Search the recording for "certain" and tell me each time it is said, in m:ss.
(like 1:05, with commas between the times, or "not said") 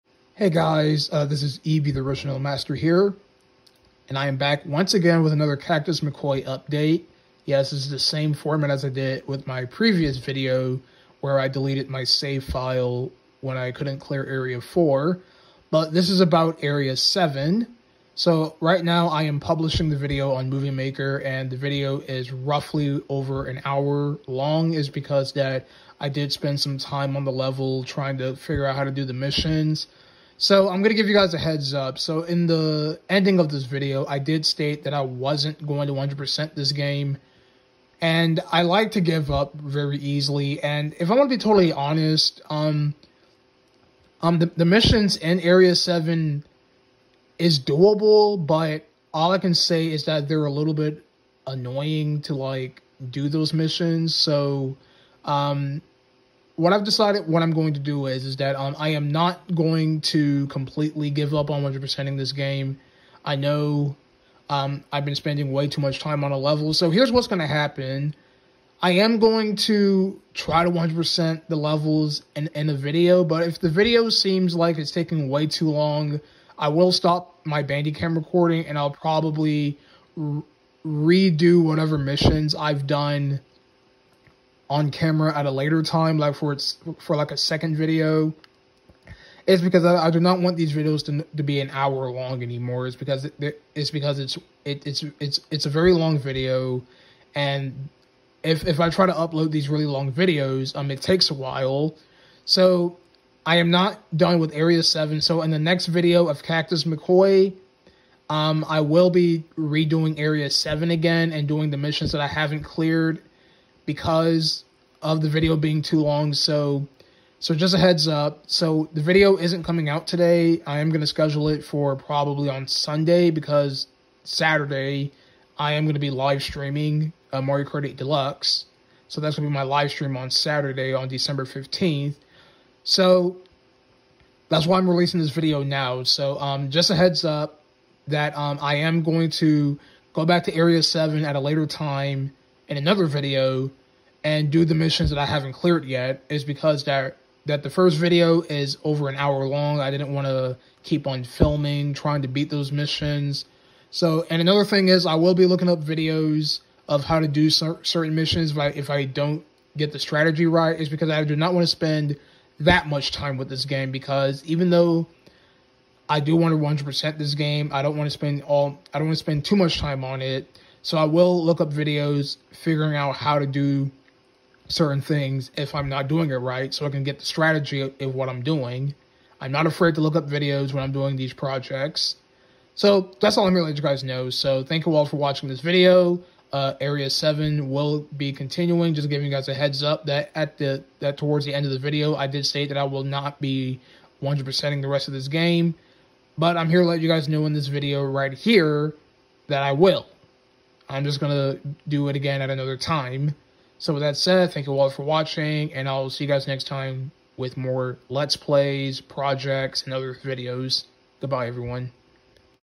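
2:37, 2:54.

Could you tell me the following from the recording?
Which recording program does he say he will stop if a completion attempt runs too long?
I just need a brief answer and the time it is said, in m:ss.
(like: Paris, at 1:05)
Bandicam, at 1:17.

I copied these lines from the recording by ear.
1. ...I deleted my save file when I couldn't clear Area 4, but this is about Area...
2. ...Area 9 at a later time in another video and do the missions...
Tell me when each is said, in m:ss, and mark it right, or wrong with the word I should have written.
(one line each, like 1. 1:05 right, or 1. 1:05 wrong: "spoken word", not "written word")
1. 0:11 right
2. 2:20 wrong: "7", not "9".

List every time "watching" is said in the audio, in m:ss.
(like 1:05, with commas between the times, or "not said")
3:05, 3:25.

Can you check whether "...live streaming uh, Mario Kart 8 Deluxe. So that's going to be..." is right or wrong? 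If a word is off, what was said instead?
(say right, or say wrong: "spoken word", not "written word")
right.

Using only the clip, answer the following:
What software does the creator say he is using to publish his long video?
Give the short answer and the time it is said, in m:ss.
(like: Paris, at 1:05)
Movie Maker, at 0:20.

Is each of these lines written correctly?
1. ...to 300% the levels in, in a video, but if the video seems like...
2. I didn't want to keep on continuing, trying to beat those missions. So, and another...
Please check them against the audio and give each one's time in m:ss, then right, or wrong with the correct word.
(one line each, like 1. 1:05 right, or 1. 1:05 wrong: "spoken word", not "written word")
1. 1:10 wrong: "100", not "300"
2. 2:29 wrong: "filming", not "continuing".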